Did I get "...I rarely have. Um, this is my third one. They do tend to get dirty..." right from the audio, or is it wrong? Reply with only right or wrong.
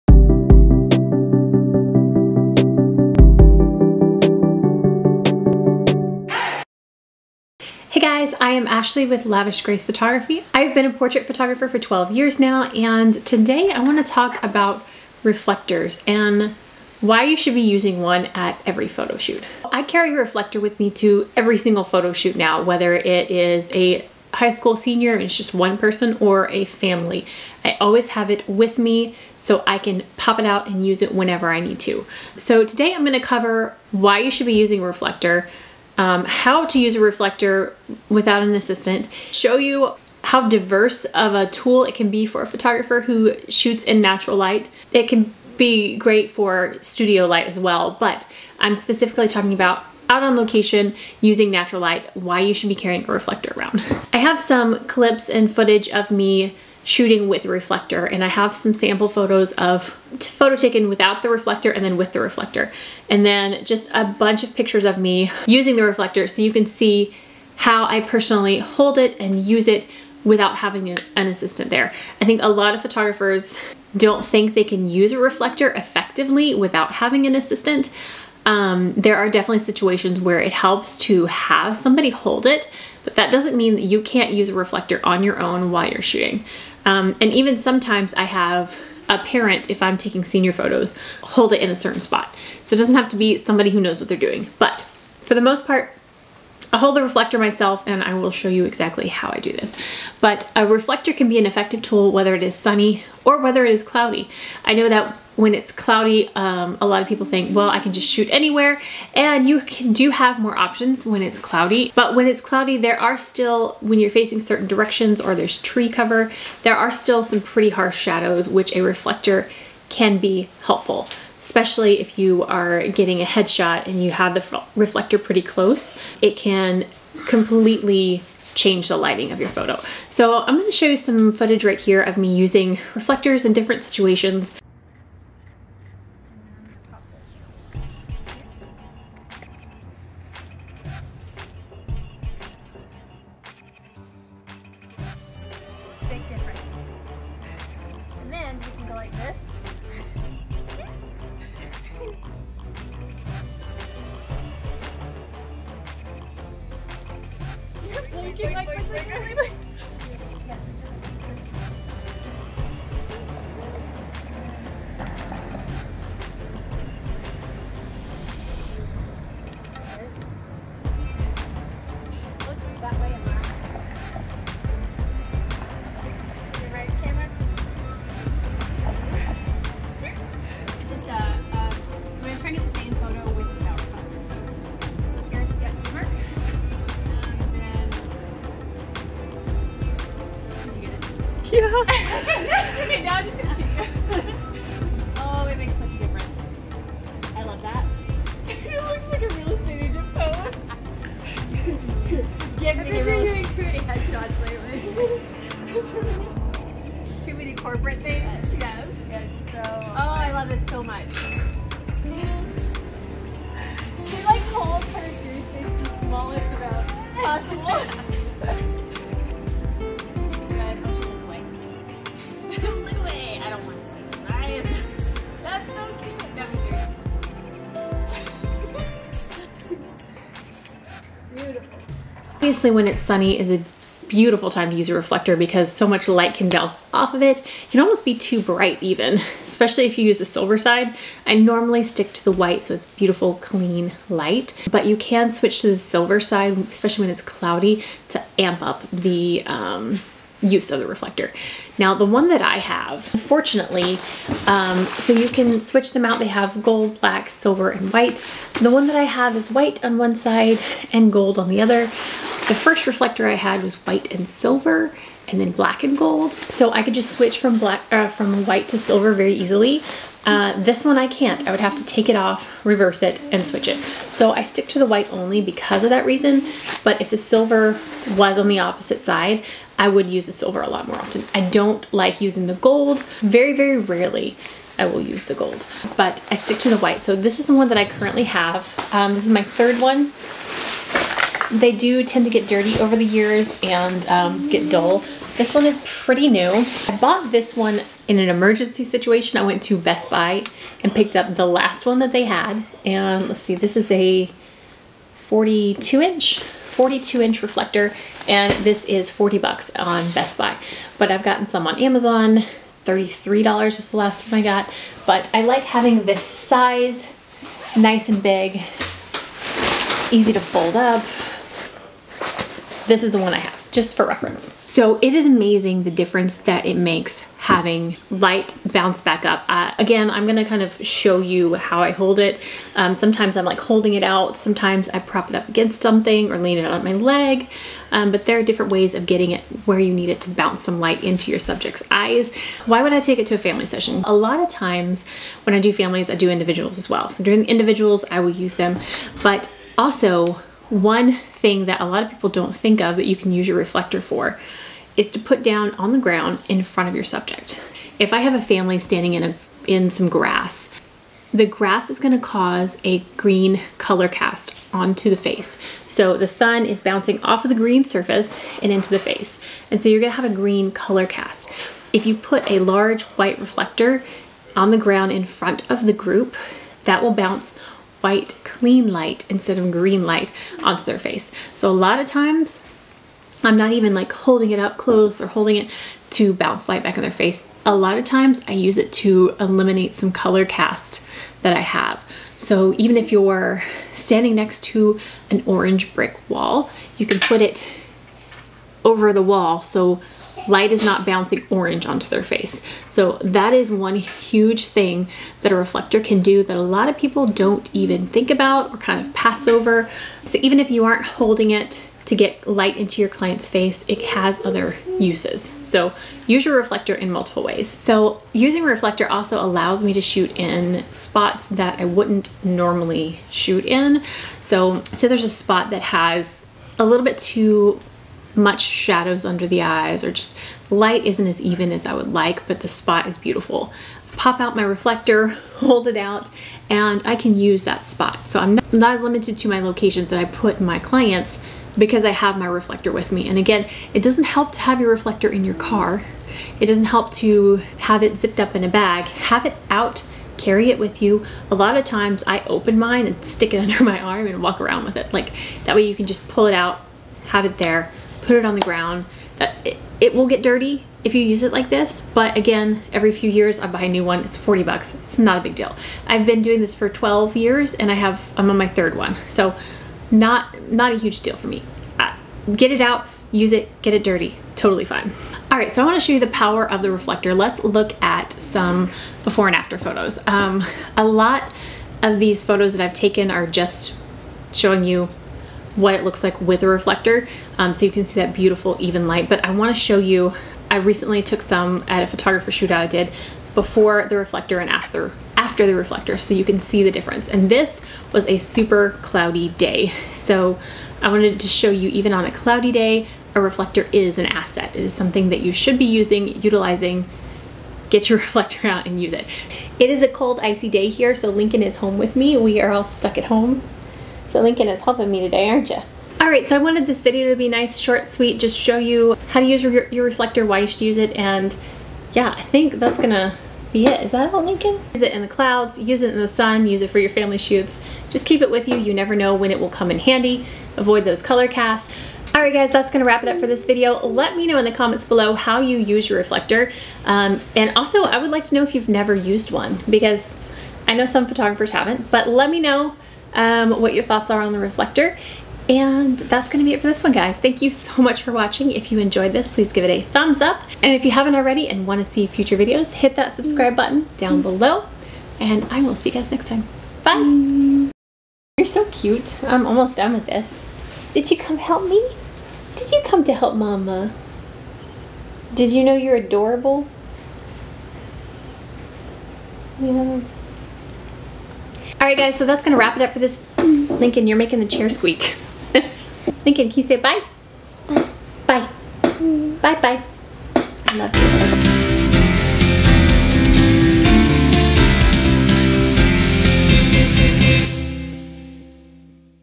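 wrong.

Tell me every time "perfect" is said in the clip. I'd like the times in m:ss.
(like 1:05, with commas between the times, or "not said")
not said.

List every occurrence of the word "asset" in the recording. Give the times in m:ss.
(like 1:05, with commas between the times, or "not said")
8:24.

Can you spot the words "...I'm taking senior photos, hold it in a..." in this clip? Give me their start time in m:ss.
1:29.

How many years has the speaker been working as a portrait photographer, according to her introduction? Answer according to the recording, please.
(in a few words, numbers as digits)
12 years.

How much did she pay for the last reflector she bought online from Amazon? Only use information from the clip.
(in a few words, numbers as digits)
$33.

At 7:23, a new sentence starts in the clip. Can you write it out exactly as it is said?
And again, it doesn't help to have your reflector in your car.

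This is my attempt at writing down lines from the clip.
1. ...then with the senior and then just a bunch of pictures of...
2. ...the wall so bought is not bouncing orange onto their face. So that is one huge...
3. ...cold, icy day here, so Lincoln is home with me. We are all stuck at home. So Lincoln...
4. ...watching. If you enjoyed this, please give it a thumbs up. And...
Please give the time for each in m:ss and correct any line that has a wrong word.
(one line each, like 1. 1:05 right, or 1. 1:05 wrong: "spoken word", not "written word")
1. 1:01 wrong: "reflector", not "senior"
2. 6:39 wrong: "light", not "bought"
3. 8:30 right
4. 9:08 right.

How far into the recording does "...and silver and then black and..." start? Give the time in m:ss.
4:24.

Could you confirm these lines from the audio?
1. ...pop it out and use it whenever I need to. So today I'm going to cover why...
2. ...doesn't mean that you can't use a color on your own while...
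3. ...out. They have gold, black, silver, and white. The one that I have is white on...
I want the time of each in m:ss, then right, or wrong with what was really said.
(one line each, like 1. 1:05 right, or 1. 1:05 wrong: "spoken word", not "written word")
1. 0:30 right
2. 1:23 wrong: "reflector", not "color"
3. 4:16 right.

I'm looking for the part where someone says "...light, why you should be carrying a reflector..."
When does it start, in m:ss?
0:51.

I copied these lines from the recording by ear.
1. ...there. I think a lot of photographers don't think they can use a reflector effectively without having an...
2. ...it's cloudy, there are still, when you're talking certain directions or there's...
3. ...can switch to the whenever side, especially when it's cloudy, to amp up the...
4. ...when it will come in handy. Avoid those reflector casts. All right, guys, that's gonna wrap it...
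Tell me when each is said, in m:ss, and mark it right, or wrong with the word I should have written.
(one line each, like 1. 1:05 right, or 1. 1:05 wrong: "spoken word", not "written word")
1. 1:11 right
2. 1:52 wrong: "facing", not "talking"
3. 4:04 wrong: "silver", not "whenever"
4. 8:49 wrong: "color", not "reflector".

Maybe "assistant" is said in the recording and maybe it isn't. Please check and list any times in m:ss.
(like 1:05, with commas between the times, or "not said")
0:38, 1:11, 1:17.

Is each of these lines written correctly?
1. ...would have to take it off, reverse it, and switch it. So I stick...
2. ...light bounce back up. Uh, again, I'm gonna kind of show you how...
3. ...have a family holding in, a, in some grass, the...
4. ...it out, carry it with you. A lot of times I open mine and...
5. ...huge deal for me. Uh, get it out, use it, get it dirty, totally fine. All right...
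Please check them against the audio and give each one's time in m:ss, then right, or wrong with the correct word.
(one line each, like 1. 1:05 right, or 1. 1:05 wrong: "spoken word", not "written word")
1. 4:31 right
2. 5:28 right
3. 5:58 wrong: "standing", not "holding"
4. 7:29 right
5. 7:50 right.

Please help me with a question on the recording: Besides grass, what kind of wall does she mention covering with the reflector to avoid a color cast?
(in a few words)
Orange brick wall.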